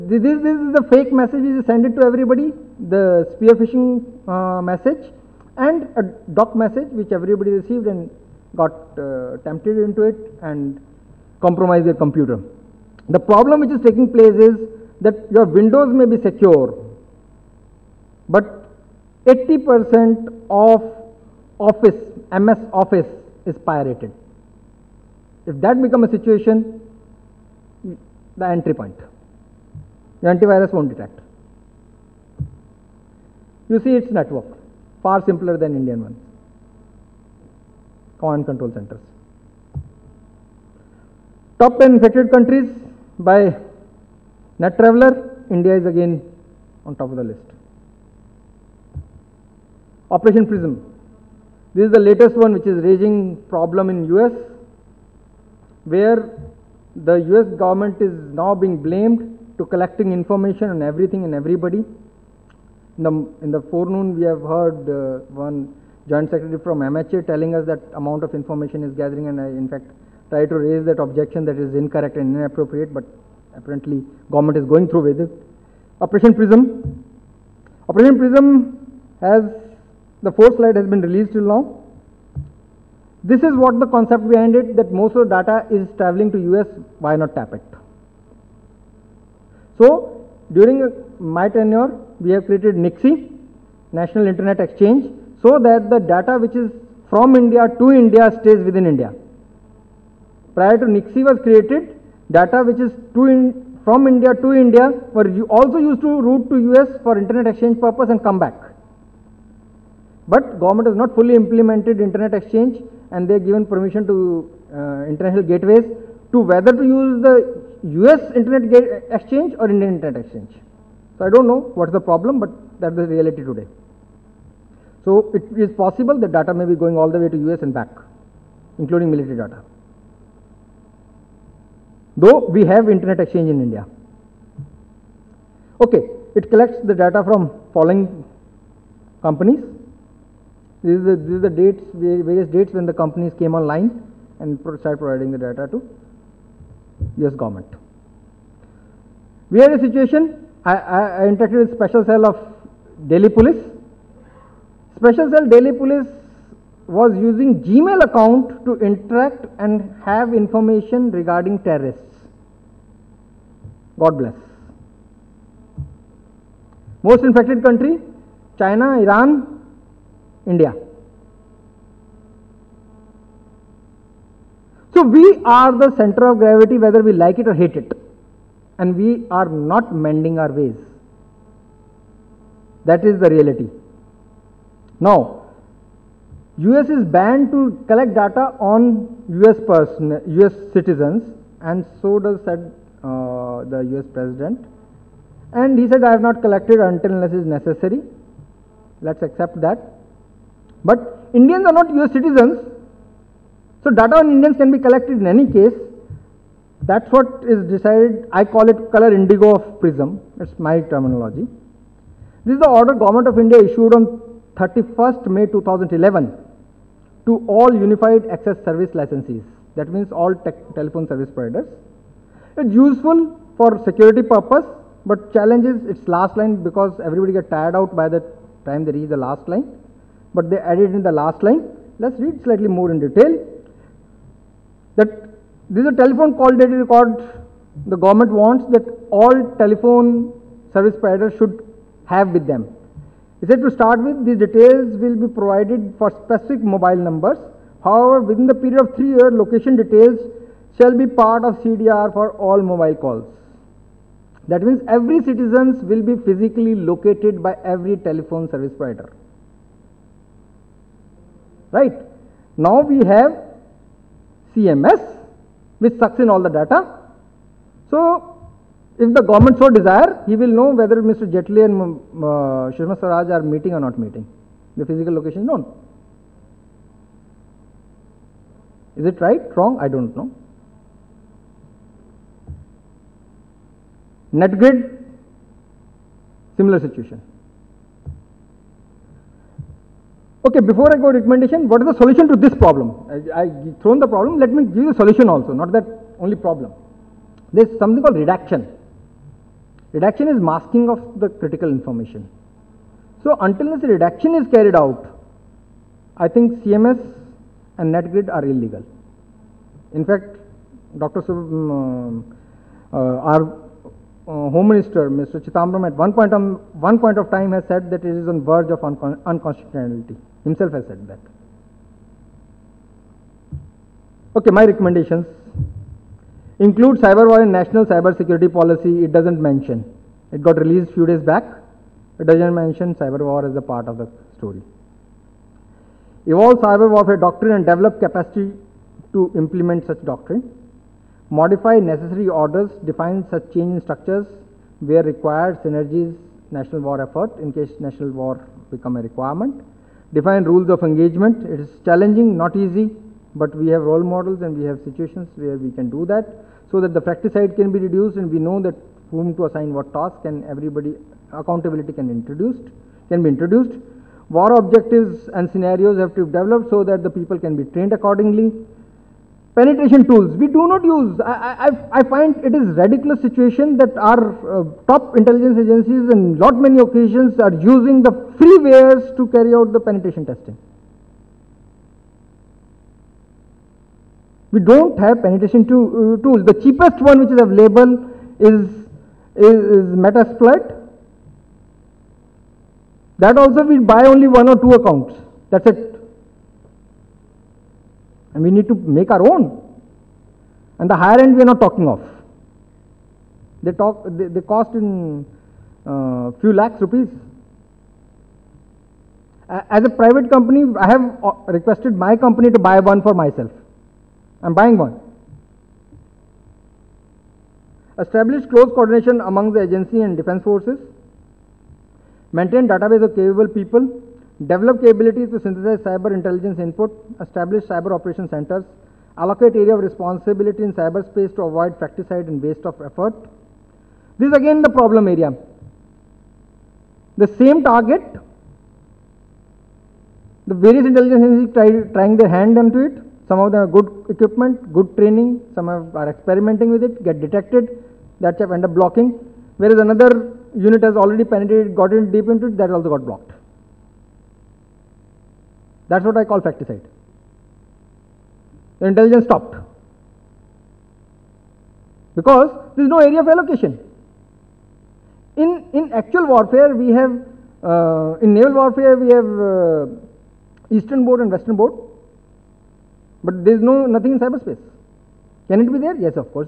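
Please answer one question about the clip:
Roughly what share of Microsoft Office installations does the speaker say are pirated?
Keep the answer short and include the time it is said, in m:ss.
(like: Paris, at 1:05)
80%, at 0:19.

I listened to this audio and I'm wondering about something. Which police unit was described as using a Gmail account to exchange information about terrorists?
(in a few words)
Special cell of Delhi police.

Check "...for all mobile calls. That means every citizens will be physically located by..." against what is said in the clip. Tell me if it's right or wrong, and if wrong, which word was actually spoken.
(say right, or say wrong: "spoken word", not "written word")
right.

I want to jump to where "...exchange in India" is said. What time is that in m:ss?
2:13.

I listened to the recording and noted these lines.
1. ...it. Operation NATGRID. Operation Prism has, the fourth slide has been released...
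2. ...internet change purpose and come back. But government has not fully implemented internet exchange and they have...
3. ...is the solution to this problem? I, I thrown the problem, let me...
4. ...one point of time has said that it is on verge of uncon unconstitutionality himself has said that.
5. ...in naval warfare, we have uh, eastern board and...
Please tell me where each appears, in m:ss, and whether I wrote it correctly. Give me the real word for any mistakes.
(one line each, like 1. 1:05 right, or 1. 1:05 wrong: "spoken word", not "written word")
1. 1:15 wrong: "Prism", not "NATGRID"
2. 1:47 wrong: "exchange", not "change"
3. 4:51 right
4. 5:16 right
5. 7:48 right.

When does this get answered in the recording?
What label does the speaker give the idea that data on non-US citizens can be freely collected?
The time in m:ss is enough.
3:28.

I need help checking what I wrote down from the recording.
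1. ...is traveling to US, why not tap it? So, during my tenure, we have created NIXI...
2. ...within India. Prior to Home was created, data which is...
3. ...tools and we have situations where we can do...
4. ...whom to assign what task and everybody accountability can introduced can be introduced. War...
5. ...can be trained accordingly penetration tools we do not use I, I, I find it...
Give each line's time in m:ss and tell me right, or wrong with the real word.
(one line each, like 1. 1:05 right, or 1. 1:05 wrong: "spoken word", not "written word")
1. 1:25 right
2. 1:38 wrong: "NIXI", not "Home"
3. 5:54 wrong: "models", not "tools"
4. 5:59 right
5. 6:07 right.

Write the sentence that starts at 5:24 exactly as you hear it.
Okay, my recommendations include cyber war in national cyber security policy.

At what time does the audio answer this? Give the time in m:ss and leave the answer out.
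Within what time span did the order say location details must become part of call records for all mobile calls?
4:08.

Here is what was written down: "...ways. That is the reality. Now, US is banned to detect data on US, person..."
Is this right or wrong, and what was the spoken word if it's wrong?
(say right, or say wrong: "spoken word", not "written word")
wrong: "collect", not "detect".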